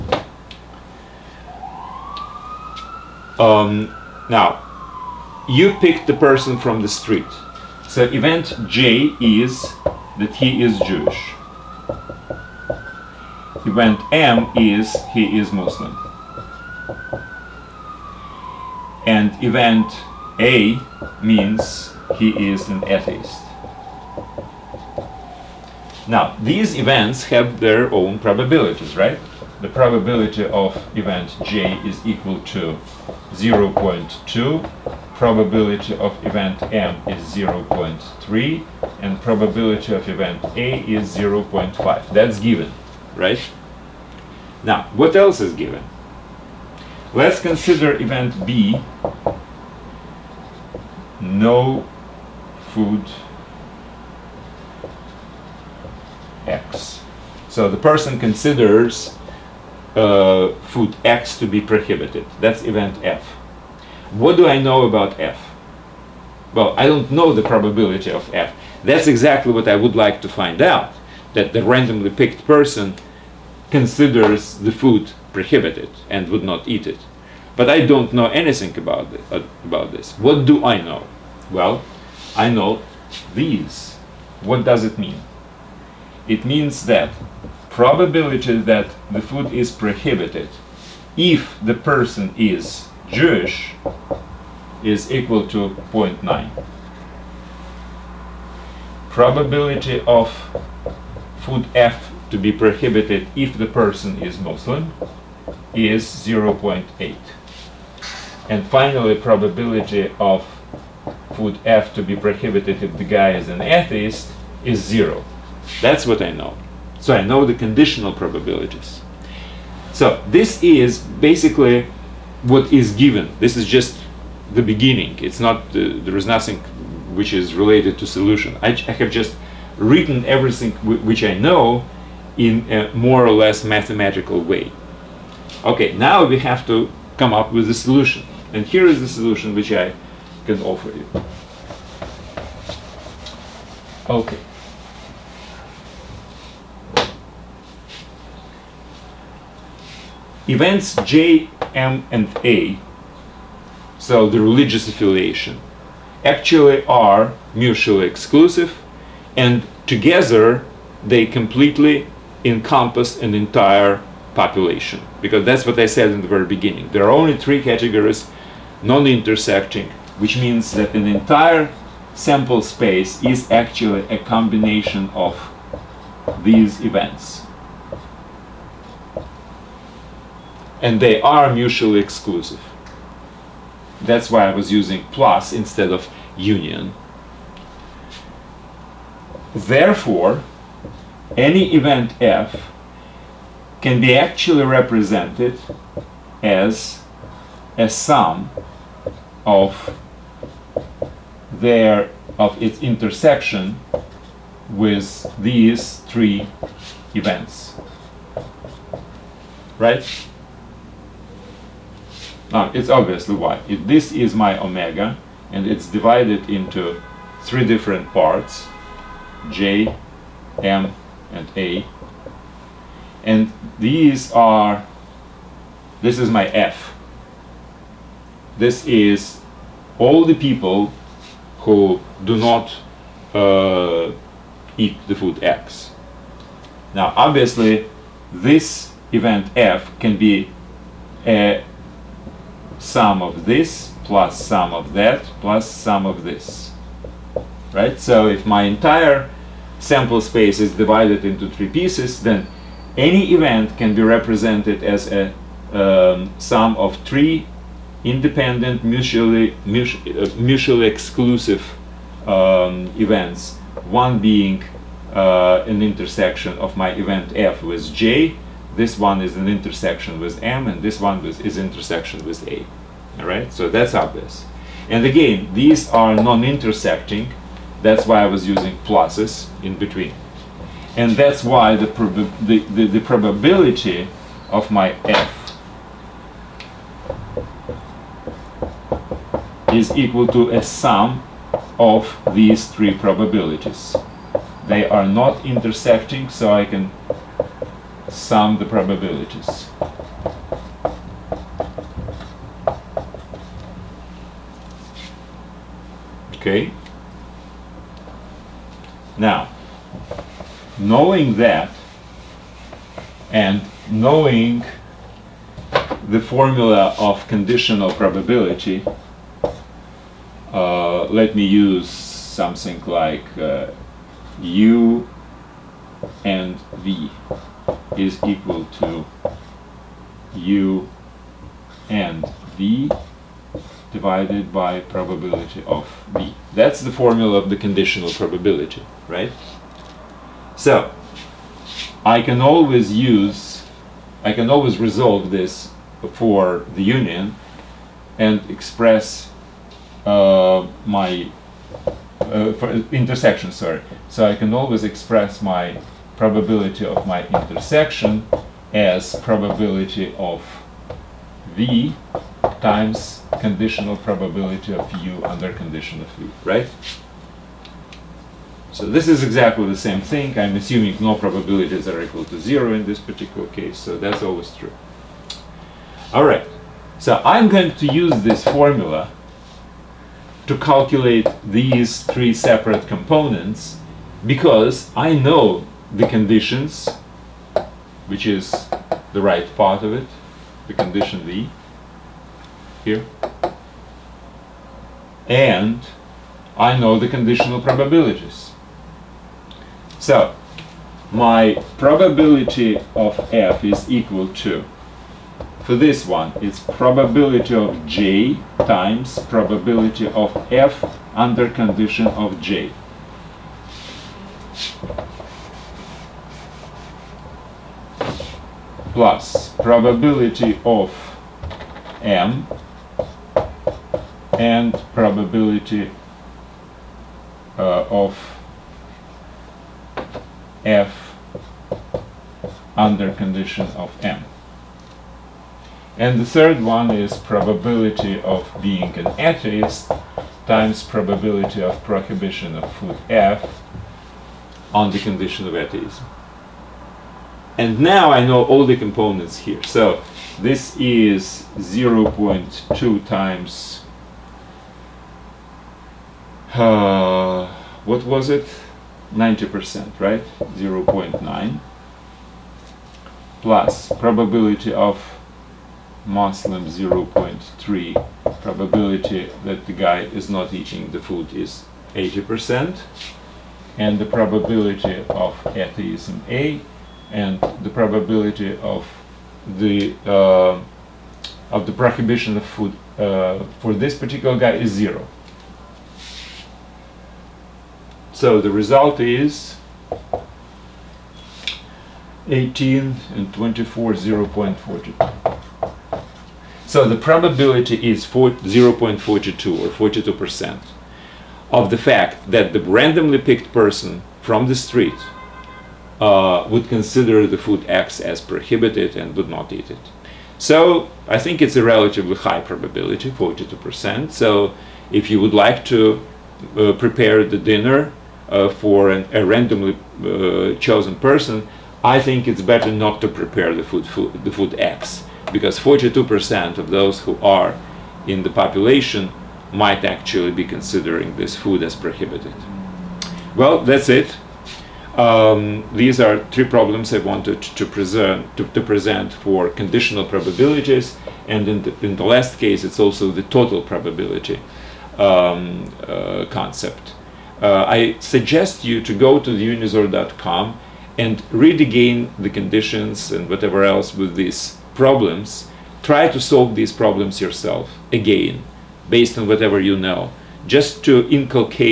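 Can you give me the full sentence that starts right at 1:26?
It means that probability that the food is prohibited if the person is Jewish is equal to 0.9.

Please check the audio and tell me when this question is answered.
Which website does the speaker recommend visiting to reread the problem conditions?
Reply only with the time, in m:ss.
9:09.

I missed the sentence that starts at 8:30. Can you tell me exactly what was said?
So I think it's a relatively high probability, 42%.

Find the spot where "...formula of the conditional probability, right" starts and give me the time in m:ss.
5:36.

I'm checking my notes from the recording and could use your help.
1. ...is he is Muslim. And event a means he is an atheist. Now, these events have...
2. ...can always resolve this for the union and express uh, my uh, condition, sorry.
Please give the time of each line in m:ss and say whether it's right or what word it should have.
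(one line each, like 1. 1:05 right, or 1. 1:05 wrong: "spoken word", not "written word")
1. 0:14 right
2. 5:44 wrong: "intersection", not "condition".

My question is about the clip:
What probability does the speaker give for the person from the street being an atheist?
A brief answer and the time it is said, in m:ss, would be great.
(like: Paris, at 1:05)
0.5, at 0:39.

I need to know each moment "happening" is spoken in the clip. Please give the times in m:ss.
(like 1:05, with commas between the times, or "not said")
not said.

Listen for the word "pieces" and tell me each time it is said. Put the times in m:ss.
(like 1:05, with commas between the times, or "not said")
4:11.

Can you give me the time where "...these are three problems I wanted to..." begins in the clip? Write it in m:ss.
8:55.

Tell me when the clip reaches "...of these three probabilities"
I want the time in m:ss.
4:51.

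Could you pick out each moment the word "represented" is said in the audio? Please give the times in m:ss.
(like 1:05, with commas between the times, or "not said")
3:14, 4:14.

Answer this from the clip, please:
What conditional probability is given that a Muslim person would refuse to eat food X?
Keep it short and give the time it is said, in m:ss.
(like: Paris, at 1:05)
0.8, at 1:46.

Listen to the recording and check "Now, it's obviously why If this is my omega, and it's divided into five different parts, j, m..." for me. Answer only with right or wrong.
wrong.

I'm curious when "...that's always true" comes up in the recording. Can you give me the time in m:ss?
6:13.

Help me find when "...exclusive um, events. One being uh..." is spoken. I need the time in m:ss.
4:20.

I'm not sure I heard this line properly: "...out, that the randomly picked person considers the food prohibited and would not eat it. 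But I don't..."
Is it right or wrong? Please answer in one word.
right.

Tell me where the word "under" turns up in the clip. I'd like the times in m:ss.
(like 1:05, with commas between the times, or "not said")
6:05, 6:51, 7:12.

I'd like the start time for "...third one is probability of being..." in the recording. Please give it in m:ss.
7:16.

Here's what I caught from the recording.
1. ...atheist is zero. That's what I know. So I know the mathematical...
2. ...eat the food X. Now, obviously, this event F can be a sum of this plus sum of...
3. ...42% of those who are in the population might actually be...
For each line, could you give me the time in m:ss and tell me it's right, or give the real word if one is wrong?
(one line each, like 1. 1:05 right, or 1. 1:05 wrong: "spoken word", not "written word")
1. 1:53 wrong: "conditional", not "mathematical"
2. 3:54 right
3. 8:45 right.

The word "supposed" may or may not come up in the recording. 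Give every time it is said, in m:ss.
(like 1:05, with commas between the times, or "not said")
not said.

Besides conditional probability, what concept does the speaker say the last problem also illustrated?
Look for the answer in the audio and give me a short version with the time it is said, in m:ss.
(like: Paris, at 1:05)
total probability, at 9:03.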